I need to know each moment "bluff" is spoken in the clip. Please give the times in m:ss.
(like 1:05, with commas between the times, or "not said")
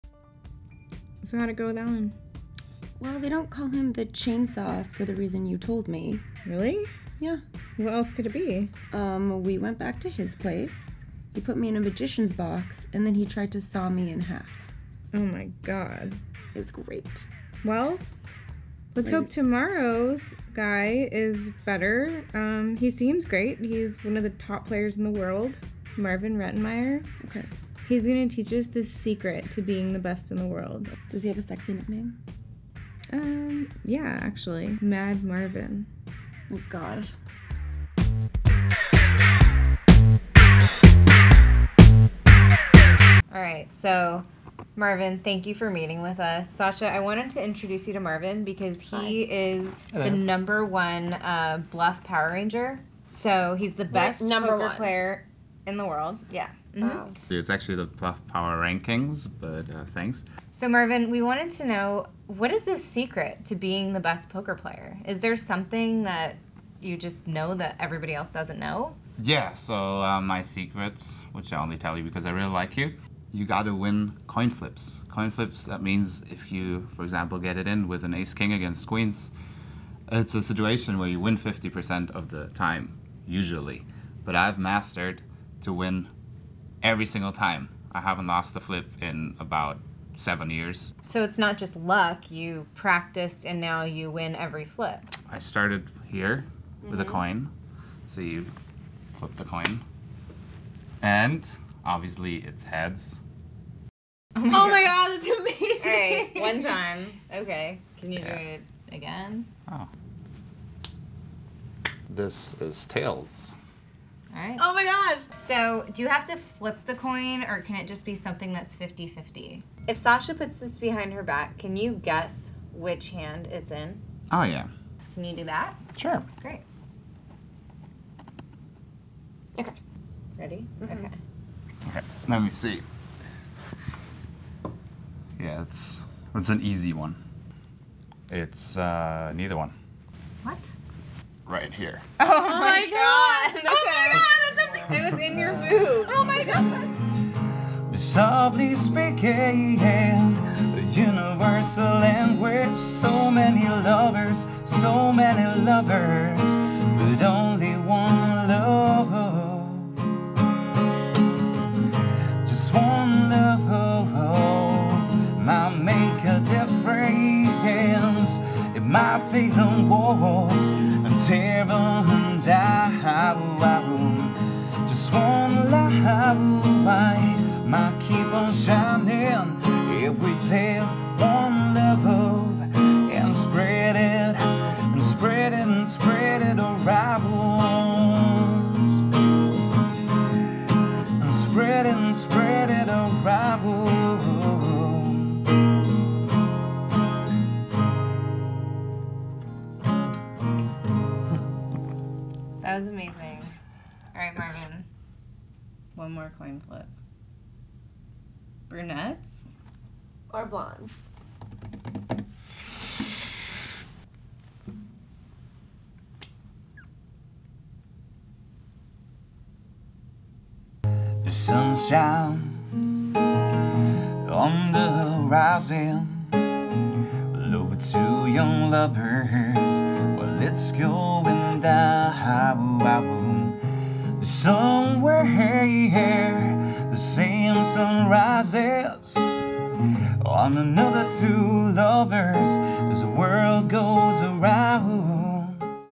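0:51, 0:57.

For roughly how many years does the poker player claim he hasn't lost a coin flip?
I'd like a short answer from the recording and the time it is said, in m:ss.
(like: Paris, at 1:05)
7, at 1:30.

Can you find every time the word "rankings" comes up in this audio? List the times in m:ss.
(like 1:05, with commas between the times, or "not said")
0:58.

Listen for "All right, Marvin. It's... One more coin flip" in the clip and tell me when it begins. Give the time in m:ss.
3:24.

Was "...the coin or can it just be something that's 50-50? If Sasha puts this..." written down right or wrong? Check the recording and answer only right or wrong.
right.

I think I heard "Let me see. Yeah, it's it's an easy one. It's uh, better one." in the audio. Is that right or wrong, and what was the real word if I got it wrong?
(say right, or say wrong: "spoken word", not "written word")
wrong: "neither", not "better".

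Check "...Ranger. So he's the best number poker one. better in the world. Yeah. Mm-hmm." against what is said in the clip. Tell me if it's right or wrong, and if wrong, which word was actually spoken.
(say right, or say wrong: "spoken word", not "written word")
wrong: "player", not "better".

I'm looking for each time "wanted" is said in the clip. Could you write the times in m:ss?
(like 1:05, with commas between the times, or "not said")
0:46, 1:01.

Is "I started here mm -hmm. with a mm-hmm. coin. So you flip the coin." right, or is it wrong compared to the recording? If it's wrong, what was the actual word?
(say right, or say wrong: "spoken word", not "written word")
right.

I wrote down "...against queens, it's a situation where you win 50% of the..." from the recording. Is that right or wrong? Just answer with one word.
right.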